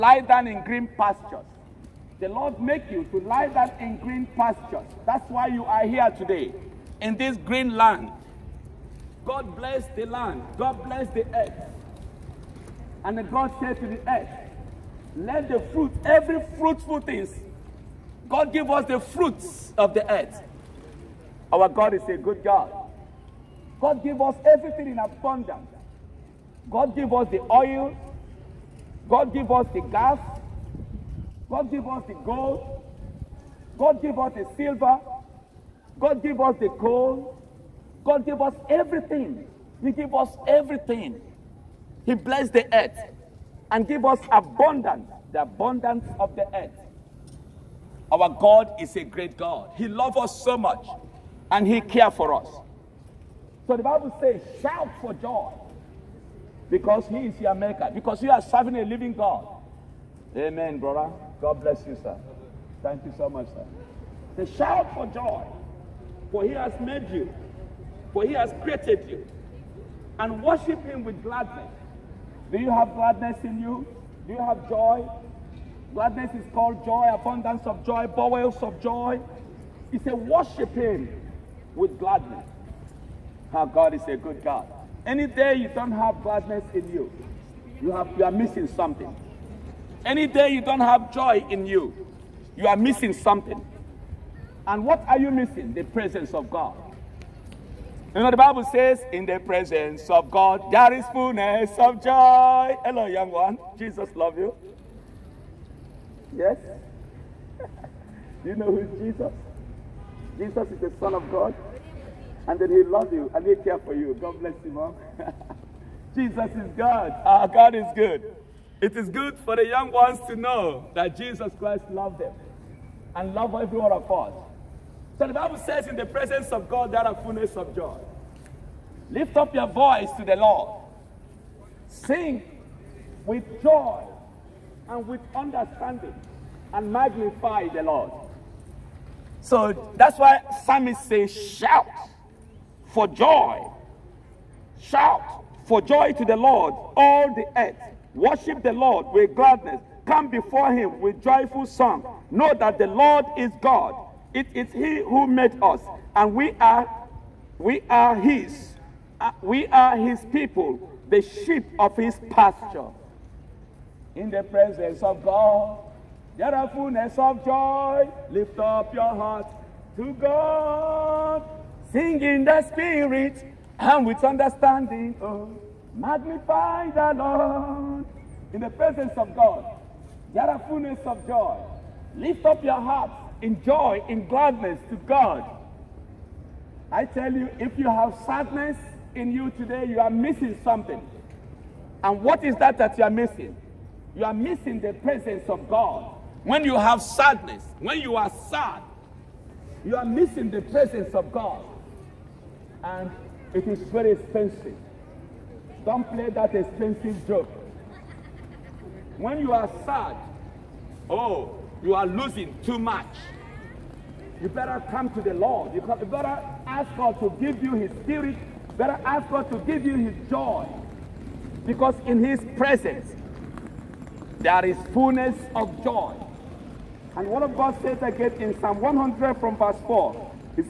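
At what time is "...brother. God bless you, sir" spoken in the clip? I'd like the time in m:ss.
1:00.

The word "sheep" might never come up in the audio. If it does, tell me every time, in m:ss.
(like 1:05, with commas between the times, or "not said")
2:41.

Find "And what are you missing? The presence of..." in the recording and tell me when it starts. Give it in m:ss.
1:34.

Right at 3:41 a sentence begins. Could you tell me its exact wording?
Because in his presence, there is fullness of joy.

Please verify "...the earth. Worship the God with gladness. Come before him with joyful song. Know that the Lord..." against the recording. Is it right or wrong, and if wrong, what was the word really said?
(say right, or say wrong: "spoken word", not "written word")
wrong: "Lord", not "God".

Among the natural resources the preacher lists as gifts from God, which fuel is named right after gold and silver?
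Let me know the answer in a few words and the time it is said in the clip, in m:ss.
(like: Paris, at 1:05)
coal, at 0:36.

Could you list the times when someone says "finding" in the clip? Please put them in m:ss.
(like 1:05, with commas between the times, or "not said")
not said.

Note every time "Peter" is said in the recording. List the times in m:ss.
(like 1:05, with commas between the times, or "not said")
not said.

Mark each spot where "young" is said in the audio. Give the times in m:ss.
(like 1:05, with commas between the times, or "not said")
1:43, 1:59.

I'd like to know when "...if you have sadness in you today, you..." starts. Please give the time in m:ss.
3:07.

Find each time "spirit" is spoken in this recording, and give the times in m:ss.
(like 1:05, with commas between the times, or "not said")
2:52, 3:38.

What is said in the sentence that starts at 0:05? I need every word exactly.
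That's why you are here today, in this green land.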